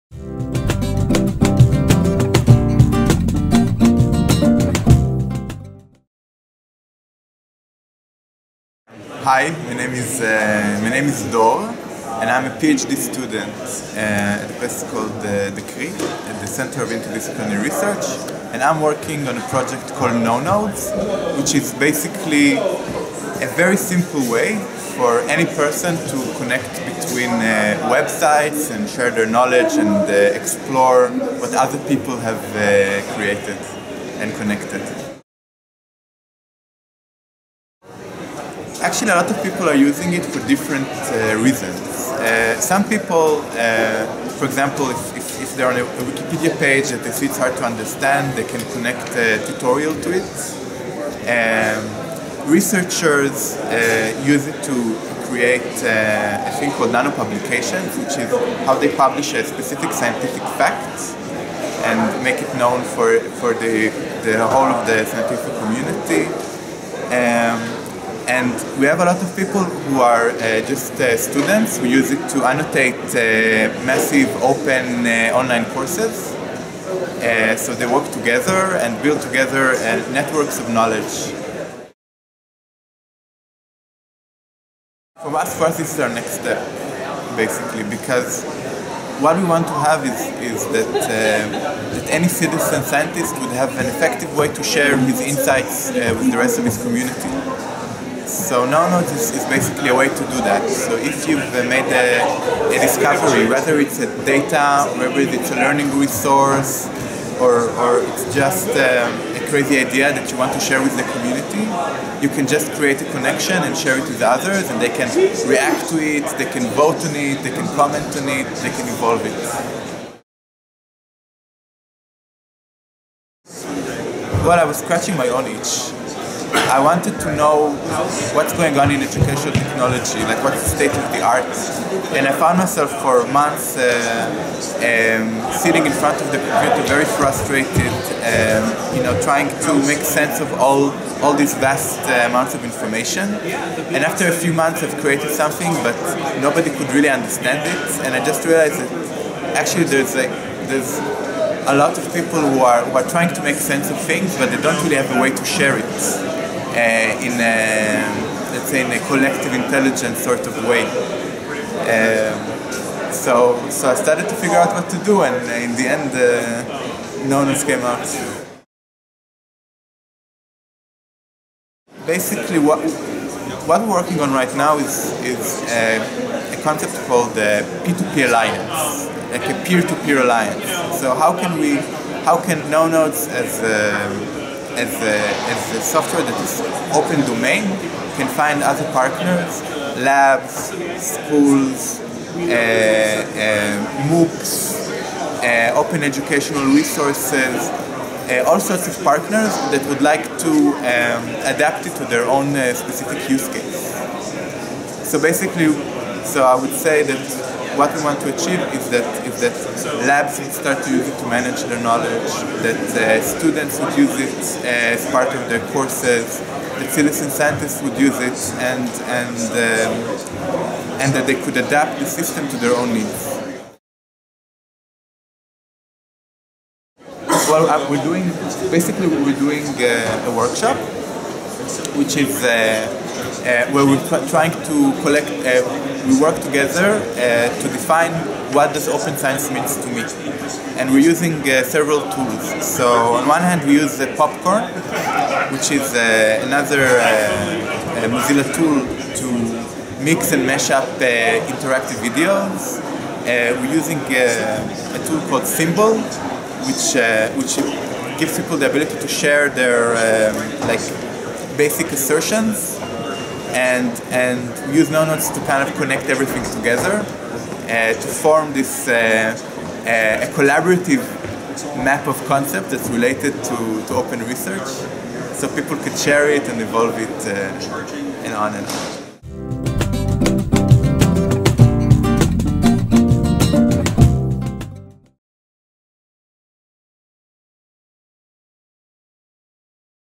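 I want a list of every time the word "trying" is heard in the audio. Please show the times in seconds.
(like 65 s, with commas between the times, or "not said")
139 s, 153 s, 234 s.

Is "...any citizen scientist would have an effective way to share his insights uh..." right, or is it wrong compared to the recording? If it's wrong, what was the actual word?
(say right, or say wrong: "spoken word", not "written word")
right.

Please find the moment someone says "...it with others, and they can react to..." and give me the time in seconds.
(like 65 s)
113 s.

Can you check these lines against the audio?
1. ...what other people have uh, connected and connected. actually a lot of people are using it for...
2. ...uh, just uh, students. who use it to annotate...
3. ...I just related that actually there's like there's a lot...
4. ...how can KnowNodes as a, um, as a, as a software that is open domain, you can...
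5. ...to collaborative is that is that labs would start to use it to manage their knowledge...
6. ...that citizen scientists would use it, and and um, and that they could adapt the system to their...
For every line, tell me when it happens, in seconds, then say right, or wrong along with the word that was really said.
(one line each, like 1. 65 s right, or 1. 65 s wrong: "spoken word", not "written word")
1. 31 s wrong: "created", not "connected"
2. 70 s right
3. 148 s wrong: "realized", not "related"
4. 182 s right
5. 208 s wrong: "achieve", not "collaborative"
6. 216 s right.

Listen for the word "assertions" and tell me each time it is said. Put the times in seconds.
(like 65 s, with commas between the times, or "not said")
261 s.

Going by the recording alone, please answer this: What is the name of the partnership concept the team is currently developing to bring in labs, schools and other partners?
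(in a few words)
P2P alliance.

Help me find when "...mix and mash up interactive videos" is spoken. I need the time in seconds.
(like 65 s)
250 s.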